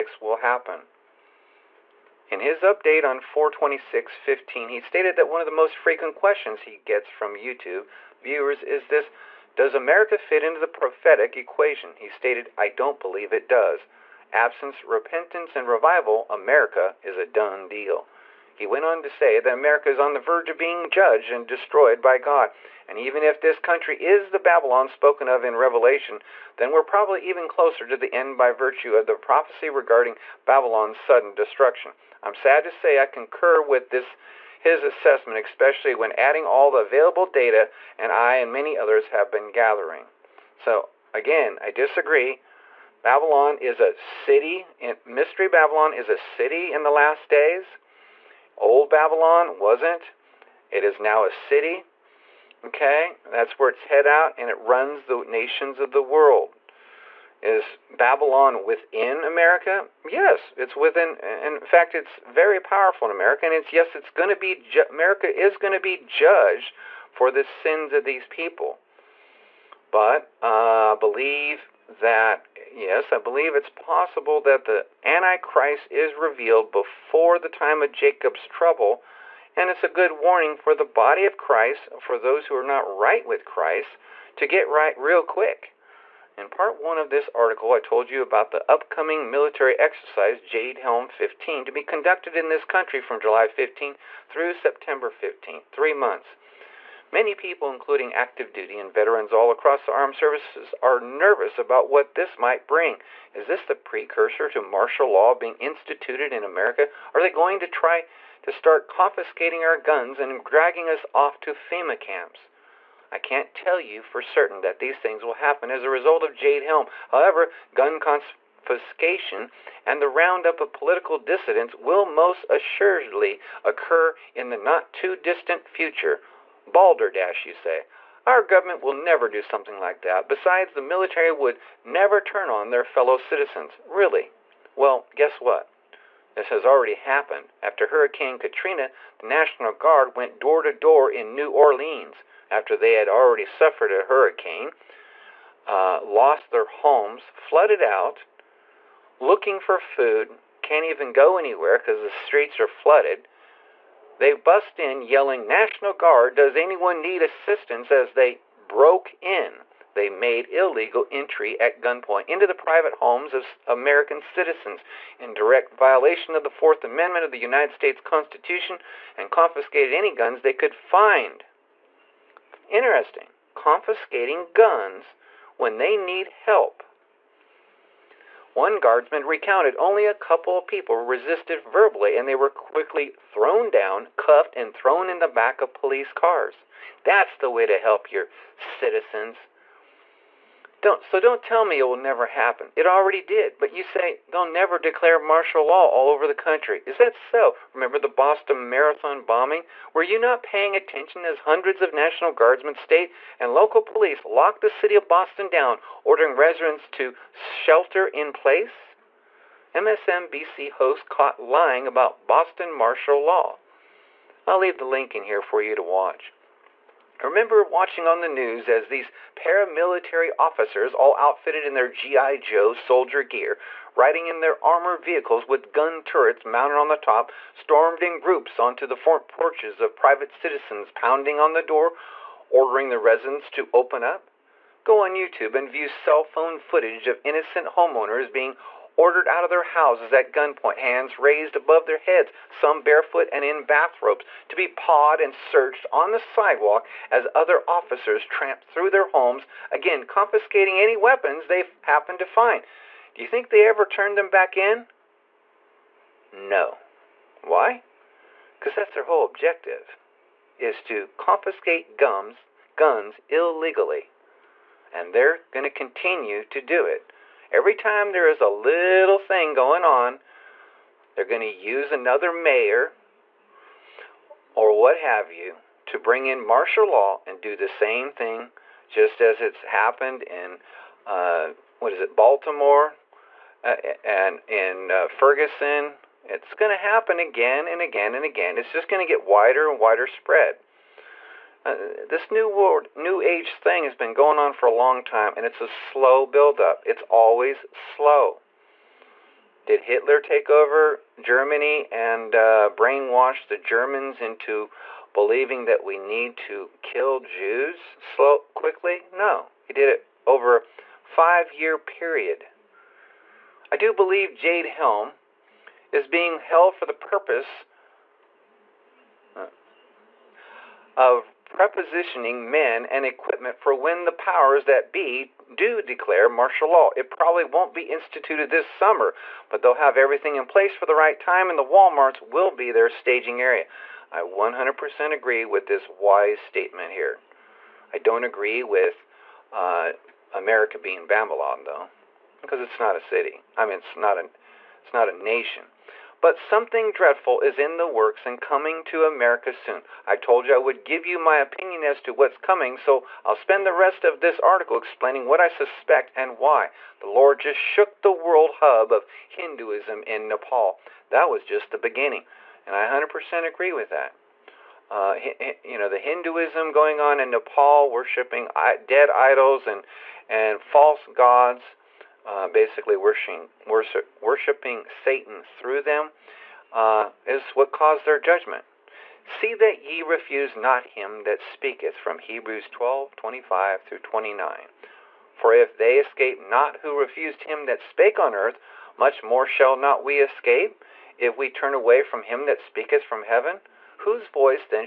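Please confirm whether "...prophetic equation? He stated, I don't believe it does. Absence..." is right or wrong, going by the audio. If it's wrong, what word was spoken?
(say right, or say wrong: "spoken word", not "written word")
right.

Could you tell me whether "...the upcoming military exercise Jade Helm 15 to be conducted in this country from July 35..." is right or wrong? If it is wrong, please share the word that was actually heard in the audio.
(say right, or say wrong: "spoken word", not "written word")
wrong: "15", not "35".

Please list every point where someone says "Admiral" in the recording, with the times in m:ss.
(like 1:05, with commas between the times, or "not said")
not said.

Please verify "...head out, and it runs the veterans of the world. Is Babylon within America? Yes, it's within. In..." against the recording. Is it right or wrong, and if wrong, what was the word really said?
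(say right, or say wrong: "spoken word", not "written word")
wrong: "nations", not "veterans".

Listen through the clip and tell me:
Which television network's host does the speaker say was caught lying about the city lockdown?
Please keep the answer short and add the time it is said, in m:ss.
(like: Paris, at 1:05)
MSNBC, at 3:29.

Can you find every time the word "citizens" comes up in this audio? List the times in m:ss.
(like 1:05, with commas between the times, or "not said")
2:13, 2:44, 3:08, 3:50.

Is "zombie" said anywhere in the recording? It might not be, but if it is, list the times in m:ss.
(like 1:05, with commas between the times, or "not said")
not said.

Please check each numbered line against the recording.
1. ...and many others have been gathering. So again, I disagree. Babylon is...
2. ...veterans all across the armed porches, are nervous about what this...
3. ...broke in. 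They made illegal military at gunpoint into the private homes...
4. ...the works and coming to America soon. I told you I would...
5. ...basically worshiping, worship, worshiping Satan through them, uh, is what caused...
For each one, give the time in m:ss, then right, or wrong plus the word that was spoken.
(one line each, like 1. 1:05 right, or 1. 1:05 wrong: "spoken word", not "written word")
1. 0:38 right
2. 1:38 wrong: "services", not "porches"
3. 2:38 wrong: "entry", not "military"
4. 5:47 right
5. 6:12 right.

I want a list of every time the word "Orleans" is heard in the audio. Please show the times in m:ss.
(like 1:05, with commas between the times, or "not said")
2:21.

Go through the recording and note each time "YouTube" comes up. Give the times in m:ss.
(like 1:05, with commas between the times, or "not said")
0:07, 3:55.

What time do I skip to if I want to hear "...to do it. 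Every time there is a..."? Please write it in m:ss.
4:26.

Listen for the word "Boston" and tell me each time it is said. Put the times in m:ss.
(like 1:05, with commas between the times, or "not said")
3:18, 3:25, 3:32.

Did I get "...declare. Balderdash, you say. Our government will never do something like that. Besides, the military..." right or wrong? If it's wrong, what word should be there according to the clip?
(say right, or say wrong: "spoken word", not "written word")
wrong: "future", not "declare".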